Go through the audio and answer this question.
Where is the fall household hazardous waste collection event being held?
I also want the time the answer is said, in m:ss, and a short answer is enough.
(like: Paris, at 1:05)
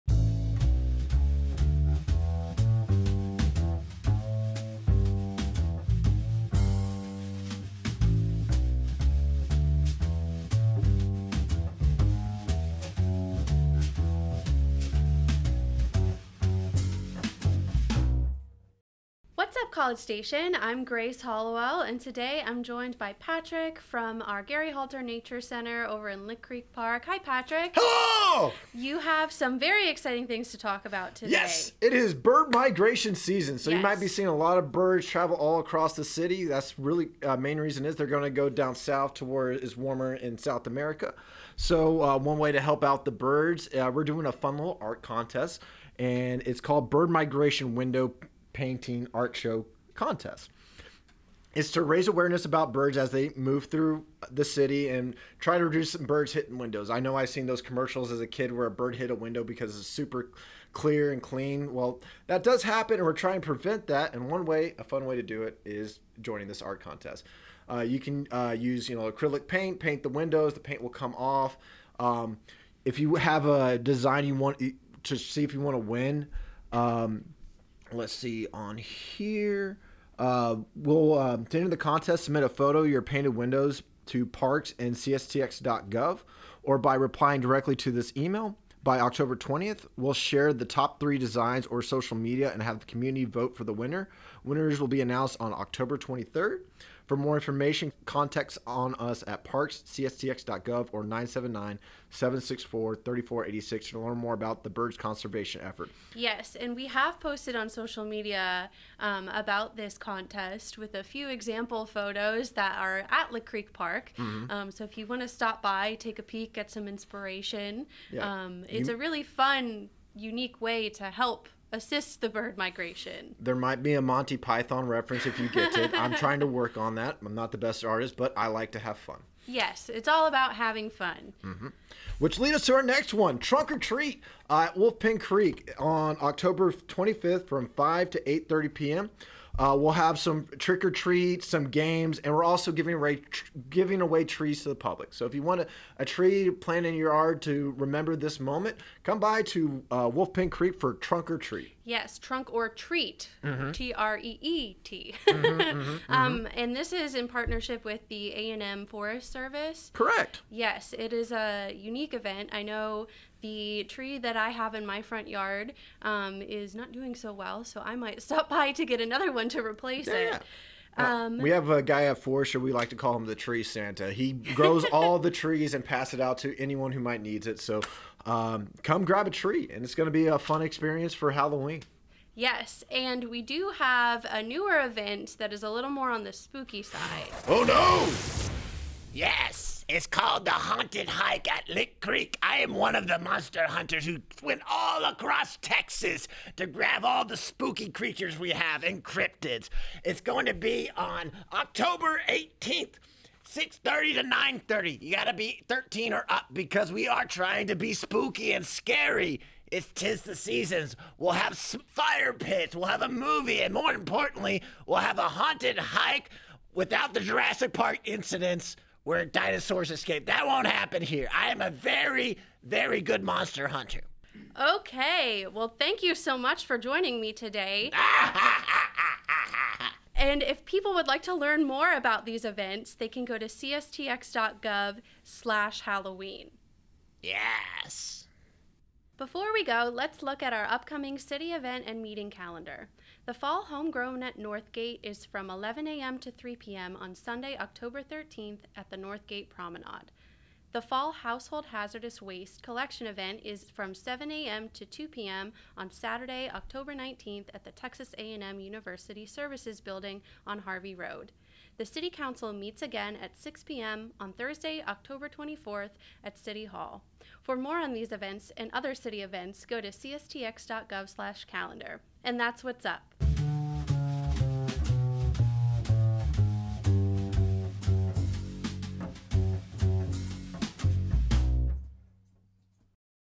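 Texas A&M University Services Building, at 4:17.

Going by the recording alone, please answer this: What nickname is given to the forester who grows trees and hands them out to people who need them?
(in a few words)
Tree Santa.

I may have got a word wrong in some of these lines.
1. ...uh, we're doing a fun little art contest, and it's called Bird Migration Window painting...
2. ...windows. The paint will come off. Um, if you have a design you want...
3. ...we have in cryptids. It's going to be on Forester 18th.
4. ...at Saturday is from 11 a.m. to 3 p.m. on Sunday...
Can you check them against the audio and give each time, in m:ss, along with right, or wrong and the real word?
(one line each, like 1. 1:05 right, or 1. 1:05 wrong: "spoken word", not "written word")
1. 0:43 right
2. 1:10 right
3. 3:18 wrong: "October", not "Forester"
4. 4:04 wrong: "Northgate", not "Saturday".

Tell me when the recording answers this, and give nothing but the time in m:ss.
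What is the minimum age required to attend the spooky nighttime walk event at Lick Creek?
3:25.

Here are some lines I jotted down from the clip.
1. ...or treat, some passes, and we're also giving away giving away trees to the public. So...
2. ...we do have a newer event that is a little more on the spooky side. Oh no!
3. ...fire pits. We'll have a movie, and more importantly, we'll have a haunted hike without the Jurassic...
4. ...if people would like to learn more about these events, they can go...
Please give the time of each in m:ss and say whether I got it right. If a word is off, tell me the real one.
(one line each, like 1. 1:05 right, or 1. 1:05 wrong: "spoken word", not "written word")
1. 2:20 wrong: "games", not "passes"
2. 3:03 right
3. 3:31 right
4. 3:50 right.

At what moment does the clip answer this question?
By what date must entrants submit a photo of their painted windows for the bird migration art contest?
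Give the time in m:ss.
1:28.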